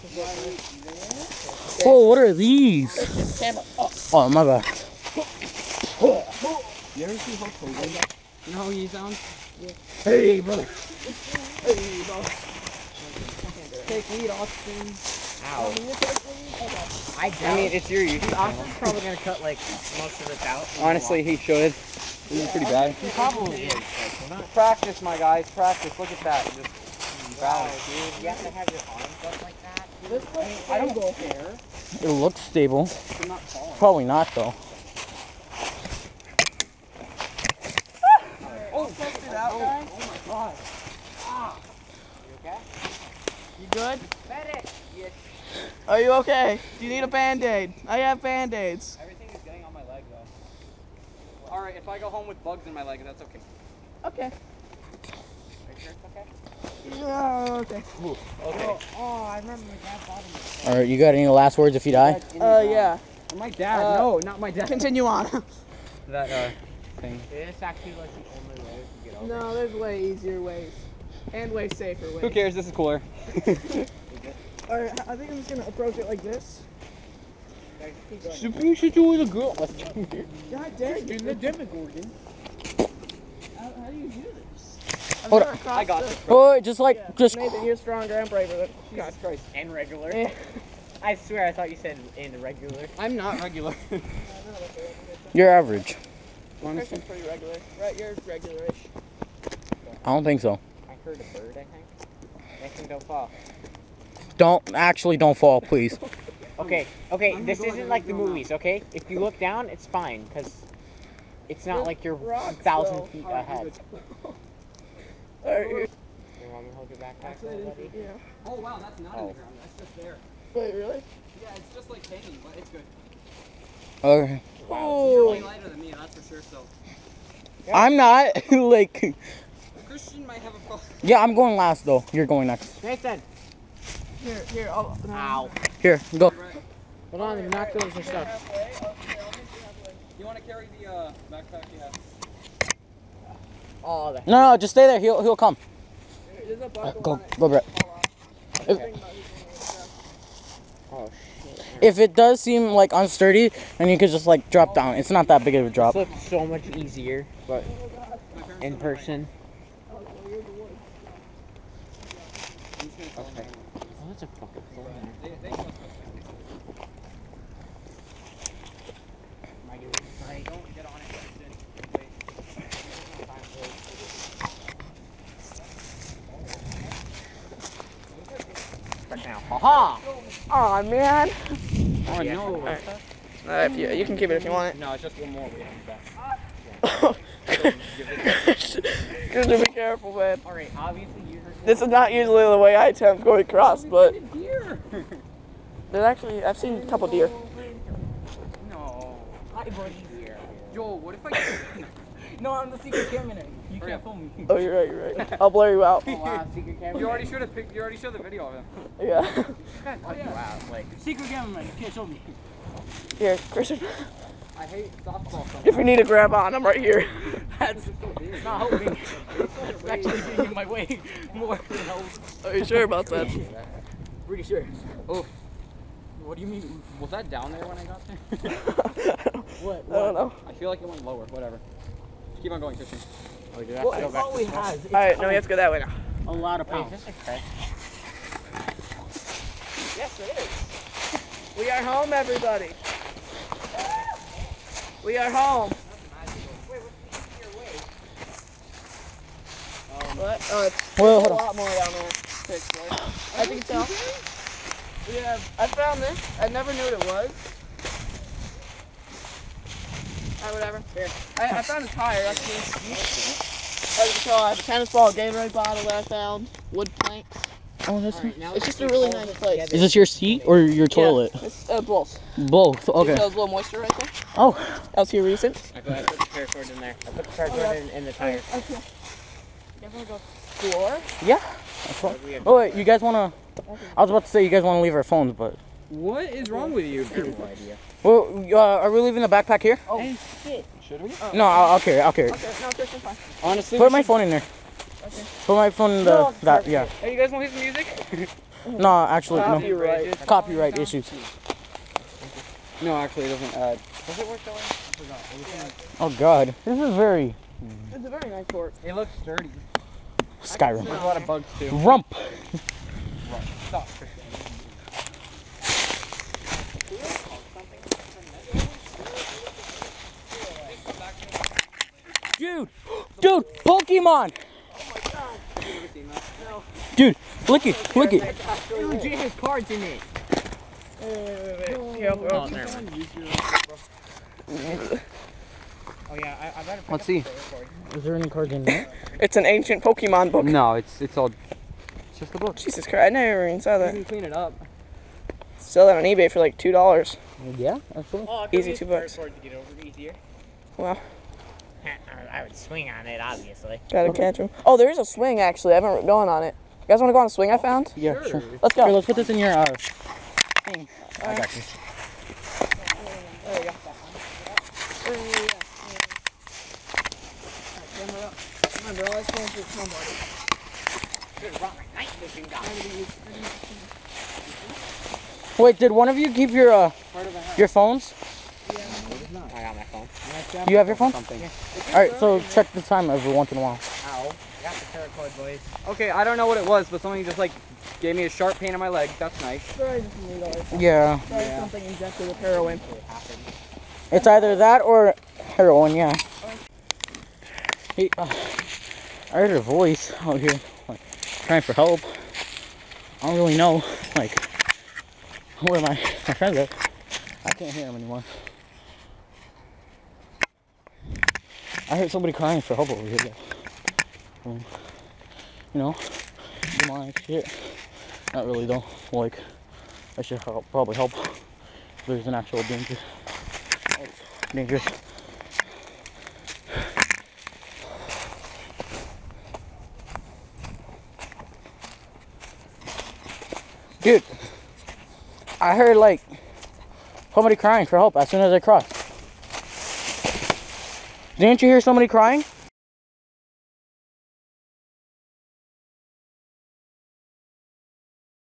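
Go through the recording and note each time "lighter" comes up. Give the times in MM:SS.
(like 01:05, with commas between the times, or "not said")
02:05.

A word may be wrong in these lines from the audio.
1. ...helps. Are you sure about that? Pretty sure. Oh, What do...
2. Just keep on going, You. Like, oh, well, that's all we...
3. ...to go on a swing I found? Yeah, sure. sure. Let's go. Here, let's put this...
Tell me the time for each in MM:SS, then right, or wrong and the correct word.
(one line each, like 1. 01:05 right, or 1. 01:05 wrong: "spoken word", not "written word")
1. 03:41 right
2. 03:52 wrong: "Christian", not "You"
3. 05:57 right.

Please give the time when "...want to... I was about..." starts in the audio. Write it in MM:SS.
04:43.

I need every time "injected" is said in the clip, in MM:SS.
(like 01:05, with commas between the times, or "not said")
06:31.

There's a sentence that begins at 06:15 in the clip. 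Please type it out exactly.
Wait, did one of you keep your uh, your phones?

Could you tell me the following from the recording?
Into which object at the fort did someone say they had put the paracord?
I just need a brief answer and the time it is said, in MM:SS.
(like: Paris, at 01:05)
the tire, at 04:37.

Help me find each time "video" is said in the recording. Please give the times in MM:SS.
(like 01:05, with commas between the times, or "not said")
03:28.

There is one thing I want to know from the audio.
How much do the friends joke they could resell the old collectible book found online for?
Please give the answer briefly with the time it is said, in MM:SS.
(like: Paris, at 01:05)
$2, at 05:46.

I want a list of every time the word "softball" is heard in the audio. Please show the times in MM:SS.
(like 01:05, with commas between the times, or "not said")
03:35.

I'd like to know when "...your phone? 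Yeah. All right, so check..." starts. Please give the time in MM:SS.
06:20.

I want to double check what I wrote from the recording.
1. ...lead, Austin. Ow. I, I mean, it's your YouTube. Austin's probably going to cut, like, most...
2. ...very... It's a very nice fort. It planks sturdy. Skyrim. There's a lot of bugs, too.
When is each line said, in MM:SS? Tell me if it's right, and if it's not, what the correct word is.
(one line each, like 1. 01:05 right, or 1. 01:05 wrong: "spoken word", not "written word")
1. 00:14 right
2. 05:06 wrong: "looks", not "planks".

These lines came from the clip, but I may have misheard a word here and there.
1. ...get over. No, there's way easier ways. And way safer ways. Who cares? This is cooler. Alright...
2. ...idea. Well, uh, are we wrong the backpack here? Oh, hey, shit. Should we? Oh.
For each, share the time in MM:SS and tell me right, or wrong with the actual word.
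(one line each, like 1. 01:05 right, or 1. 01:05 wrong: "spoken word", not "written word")
1. 01:09 right
2. 04:47 wrong: "leaving", not "wrong".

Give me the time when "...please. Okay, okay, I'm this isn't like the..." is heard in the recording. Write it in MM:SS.
01:45.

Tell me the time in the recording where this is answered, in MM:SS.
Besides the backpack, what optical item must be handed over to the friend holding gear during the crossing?
02:17.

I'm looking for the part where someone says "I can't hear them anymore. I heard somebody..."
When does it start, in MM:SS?
06:47.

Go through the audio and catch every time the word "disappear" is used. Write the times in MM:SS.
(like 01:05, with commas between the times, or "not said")
not said.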